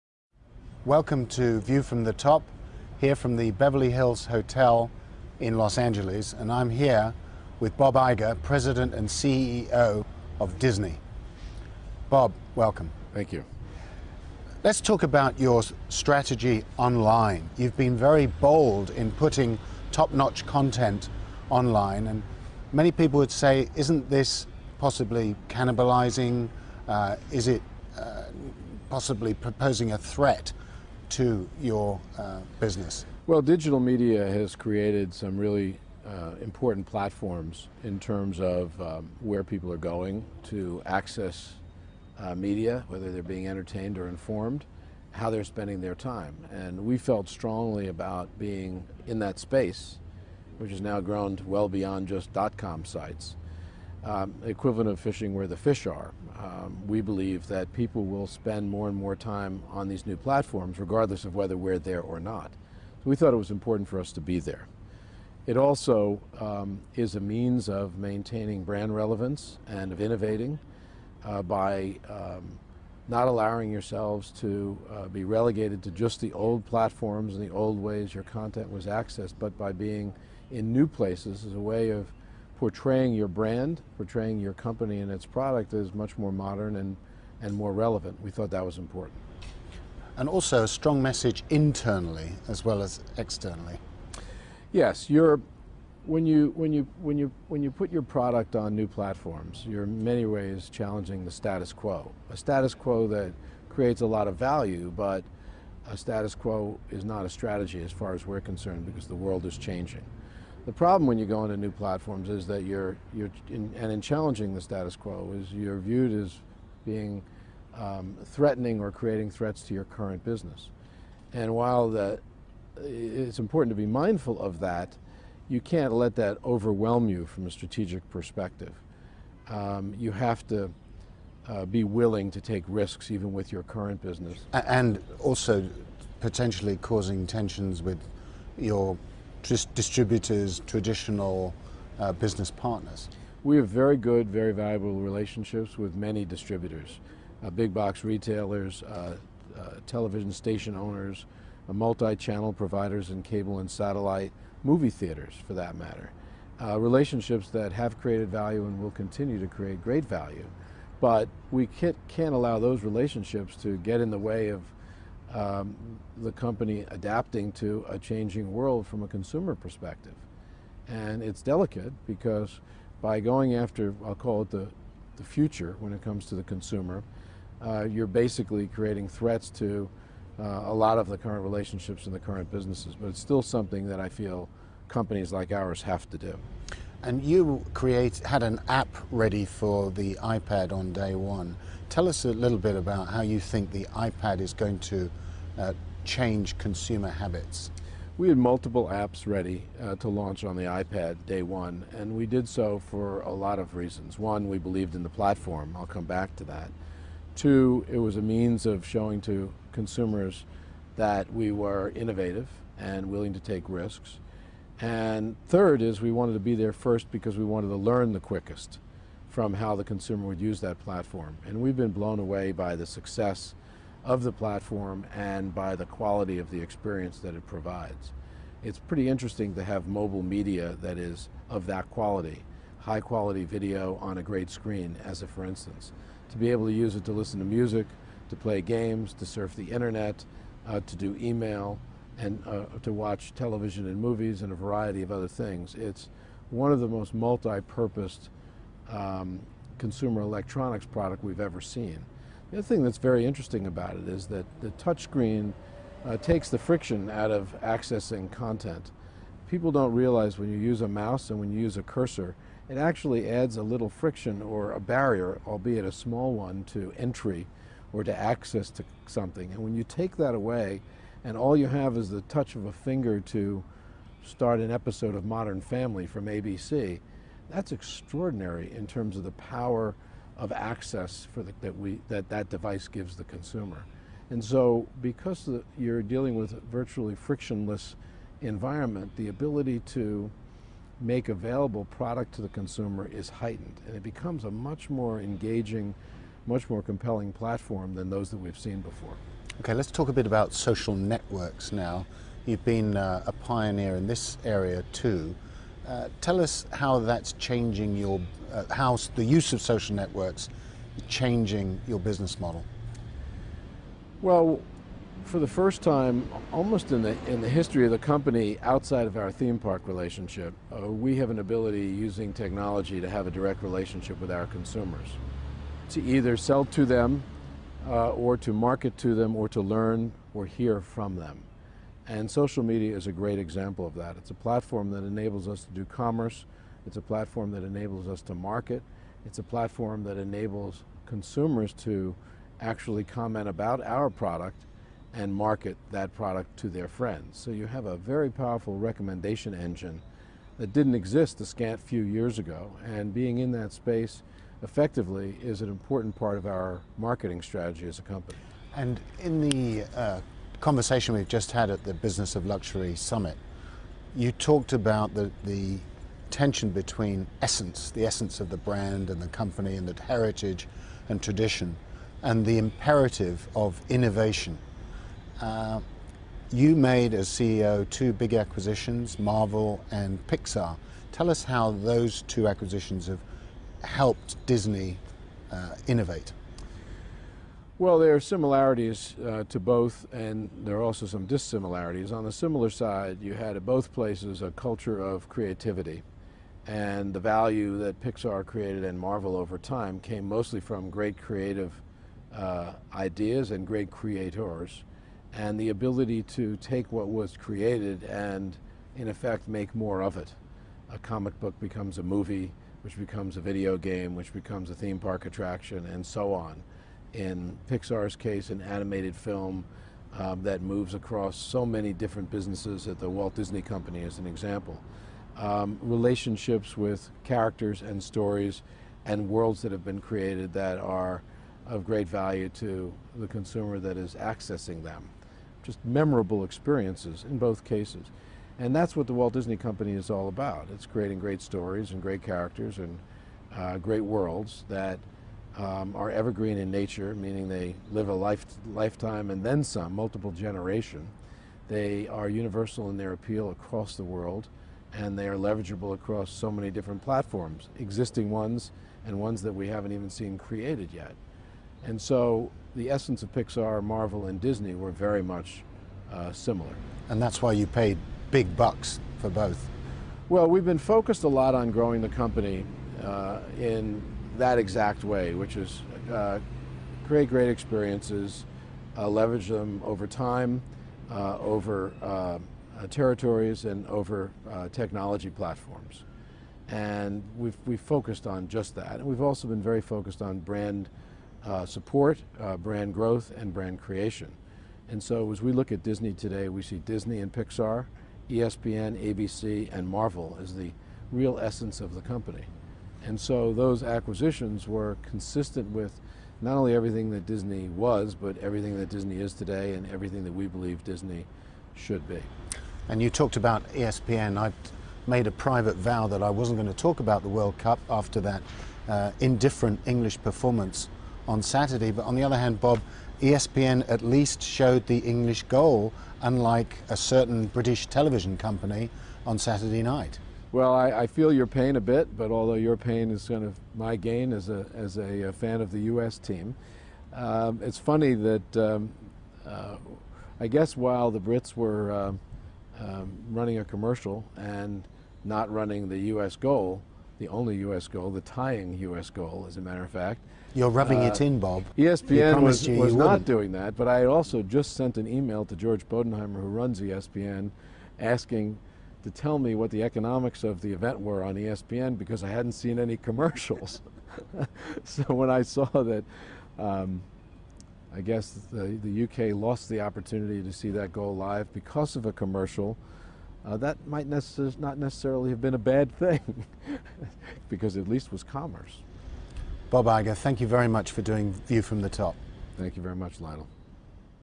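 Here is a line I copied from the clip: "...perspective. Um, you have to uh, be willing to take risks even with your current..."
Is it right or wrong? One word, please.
right.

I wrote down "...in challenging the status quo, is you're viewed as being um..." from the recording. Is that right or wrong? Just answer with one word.
right.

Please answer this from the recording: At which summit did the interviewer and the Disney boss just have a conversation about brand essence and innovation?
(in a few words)
Business of Luxury Summit.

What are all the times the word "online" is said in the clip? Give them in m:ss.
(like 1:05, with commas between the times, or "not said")
0:16, 0:21.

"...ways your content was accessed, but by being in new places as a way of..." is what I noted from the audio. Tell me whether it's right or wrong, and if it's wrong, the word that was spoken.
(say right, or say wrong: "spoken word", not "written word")
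right.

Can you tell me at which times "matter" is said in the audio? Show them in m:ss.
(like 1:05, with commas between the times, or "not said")
2:35, 9:09.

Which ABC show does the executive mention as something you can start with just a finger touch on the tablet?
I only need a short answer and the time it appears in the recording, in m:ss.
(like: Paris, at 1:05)
Modern Family, at 4:35.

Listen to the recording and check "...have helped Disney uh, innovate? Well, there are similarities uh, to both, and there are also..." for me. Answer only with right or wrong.
right.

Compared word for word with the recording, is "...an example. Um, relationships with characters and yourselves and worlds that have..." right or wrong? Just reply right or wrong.
wrong.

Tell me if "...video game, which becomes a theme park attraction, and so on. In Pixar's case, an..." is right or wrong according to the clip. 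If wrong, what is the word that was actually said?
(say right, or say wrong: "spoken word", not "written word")
right.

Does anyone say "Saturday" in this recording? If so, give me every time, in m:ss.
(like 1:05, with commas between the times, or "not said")
8:41, 8:49.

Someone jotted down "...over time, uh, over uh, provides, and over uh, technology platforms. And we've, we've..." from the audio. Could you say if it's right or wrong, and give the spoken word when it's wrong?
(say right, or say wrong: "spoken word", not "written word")
wrong: "territories", not "provides".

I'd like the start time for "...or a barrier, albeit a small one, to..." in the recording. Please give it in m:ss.
4:24.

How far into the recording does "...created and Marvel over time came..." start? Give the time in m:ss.
6:38.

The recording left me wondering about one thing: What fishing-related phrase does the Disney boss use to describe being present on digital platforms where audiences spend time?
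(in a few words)
fishing where the fish are.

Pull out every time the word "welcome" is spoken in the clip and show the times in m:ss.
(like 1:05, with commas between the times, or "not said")
0:00, 0:12.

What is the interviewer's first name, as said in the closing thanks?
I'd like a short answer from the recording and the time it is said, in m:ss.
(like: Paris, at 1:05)
Lionel, at 9:43.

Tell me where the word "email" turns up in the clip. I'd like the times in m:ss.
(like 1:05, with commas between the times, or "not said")
4:01, 9:15.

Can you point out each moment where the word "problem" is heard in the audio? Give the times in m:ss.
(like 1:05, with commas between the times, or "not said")
1:50.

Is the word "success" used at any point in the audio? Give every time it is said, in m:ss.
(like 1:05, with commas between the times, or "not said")
3:42.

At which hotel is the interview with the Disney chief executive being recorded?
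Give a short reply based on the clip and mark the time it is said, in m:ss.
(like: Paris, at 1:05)
Beverly Hills Hotel, at 0:03.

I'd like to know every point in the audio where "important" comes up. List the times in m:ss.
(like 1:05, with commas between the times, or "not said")
0:36, 1:03, 1:28, 2:03, 5:55.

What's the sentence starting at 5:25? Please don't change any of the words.
To either sell to them uh, or to market to them or to learn or hear from them.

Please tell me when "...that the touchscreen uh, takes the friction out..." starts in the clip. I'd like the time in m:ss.
4:14.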